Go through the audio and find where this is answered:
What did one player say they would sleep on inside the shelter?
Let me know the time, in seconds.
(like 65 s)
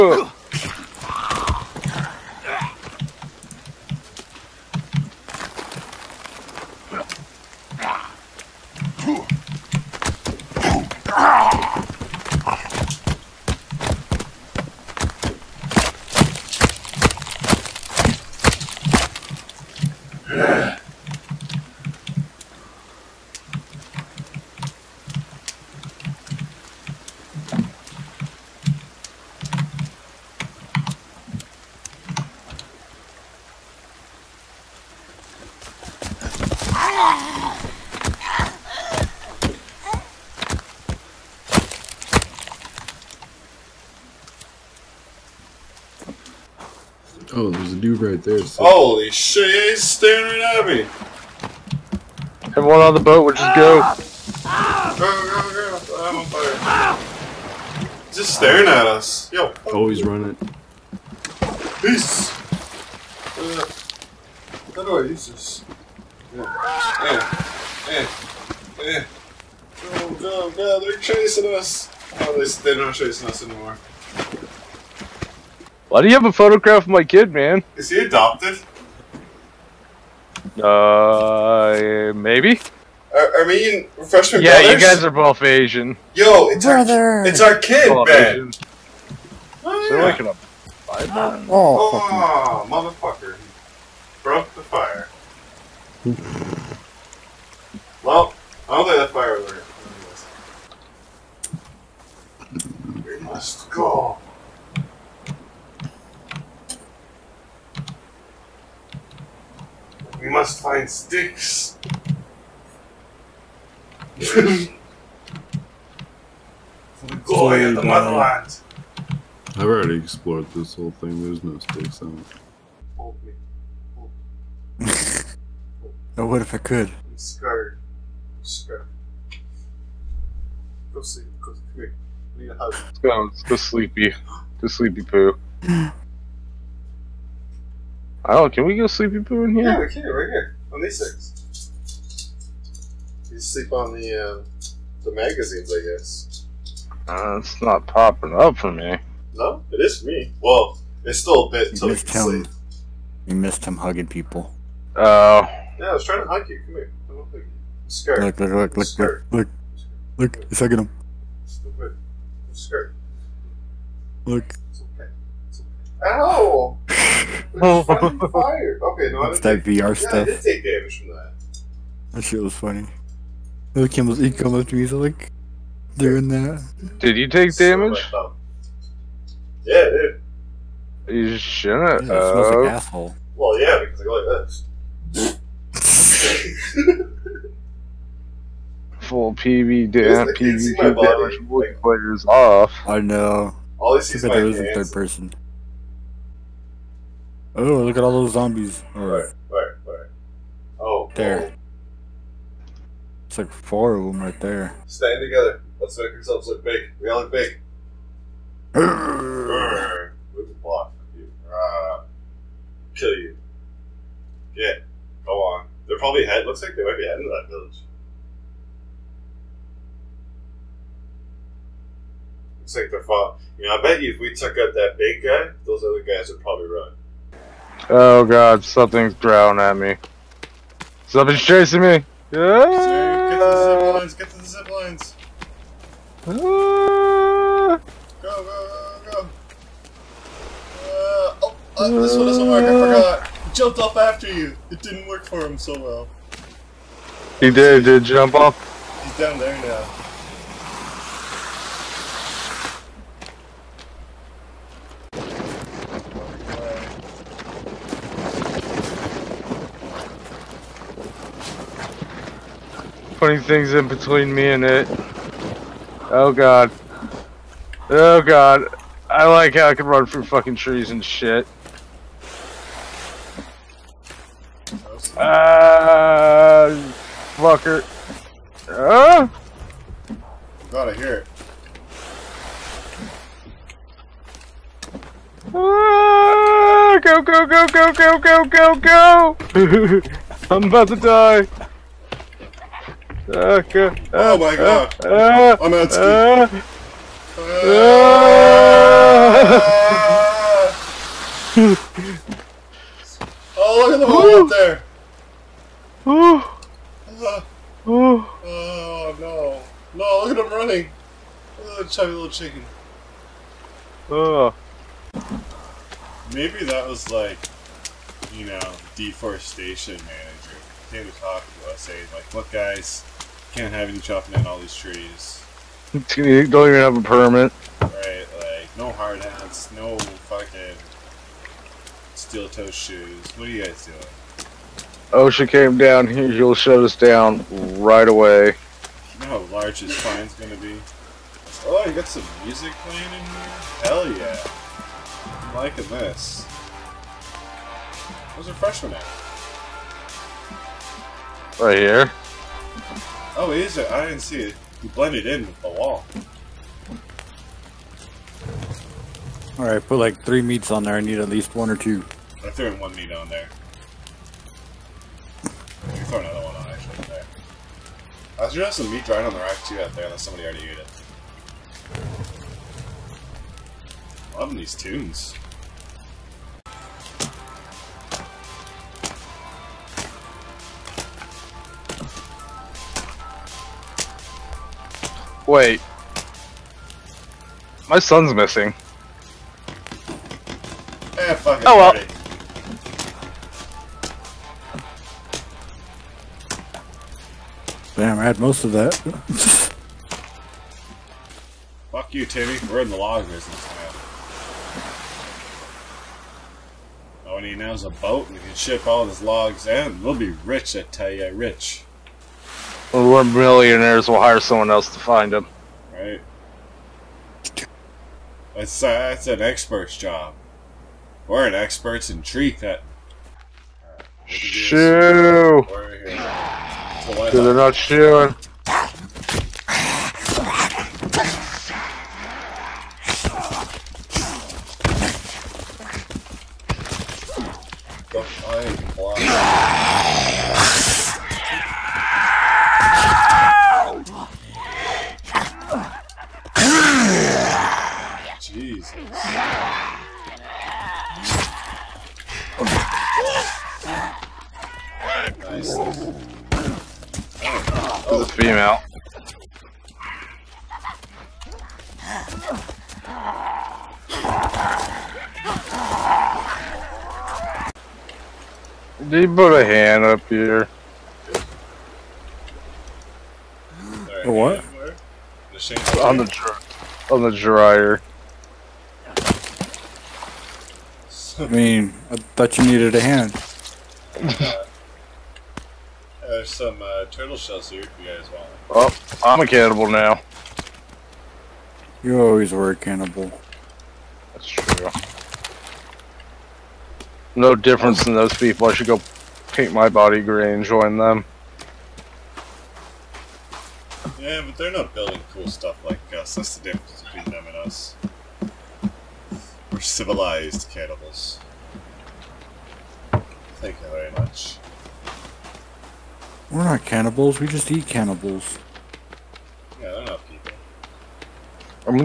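145 s.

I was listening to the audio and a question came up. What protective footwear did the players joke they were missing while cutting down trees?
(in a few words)
steel toe shoes.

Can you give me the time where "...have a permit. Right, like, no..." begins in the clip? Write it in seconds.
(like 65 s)
326 s.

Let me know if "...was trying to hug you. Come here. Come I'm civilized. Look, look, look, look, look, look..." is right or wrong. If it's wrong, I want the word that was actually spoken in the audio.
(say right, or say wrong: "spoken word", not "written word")
wrong: "scared", not "civilized".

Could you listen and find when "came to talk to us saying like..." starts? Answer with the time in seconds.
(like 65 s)
320 s.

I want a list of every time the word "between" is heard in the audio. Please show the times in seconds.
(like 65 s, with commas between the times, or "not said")
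263 s, 507 s.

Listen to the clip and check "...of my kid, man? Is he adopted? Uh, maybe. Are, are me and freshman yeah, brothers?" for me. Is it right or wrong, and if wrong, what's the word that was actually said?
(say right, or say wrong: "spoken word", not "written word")
right.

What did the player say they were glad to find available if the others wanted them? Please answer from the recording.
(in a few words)
turtle shells.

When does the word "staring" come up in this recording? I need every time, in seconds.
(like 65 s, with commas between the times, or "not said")
49 s, 58 s.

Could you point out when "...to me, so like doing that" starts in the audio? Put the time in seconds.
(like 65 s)
174 s.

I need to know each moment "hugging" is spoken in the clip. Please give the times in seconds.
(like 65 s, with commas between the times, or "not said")
153 s, 160 s.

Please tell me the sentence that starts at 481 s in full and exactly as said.
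I mean, I thought you needed a hand.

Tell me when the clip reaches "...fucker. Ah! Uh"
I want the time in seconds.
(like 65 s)
277 s.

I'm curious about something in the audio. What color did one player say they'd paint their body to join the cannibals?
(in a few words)
gray.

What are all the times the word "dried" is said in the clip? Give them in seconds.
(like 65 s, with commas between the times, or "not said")
369 s.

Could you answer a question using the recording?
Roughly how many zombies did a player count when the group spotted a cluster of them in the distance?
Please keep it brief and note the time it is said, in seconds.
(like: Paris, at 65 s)
4, at 203 s.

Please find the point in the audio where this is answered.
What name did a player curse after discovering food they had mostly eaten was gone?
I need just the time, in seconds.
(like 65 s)
402 s.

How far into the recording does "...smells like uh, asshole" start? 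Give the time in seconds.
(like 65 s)
182 s.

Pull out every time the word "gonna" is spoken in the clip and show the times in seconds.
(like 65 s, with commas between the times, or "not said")
340 s.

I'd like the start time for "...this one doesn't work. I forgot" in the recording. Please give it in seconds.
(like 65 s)
241 s.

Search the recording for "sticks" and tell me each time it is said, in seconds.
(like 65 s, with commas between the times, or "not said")
110 s, 121 s.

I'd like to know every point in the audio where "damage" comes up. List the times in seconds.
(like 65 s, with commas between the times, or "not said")
170 s, 177 s, 191 s.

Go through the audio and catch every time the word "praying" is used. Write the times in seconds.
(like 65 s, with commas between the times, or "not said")
not said.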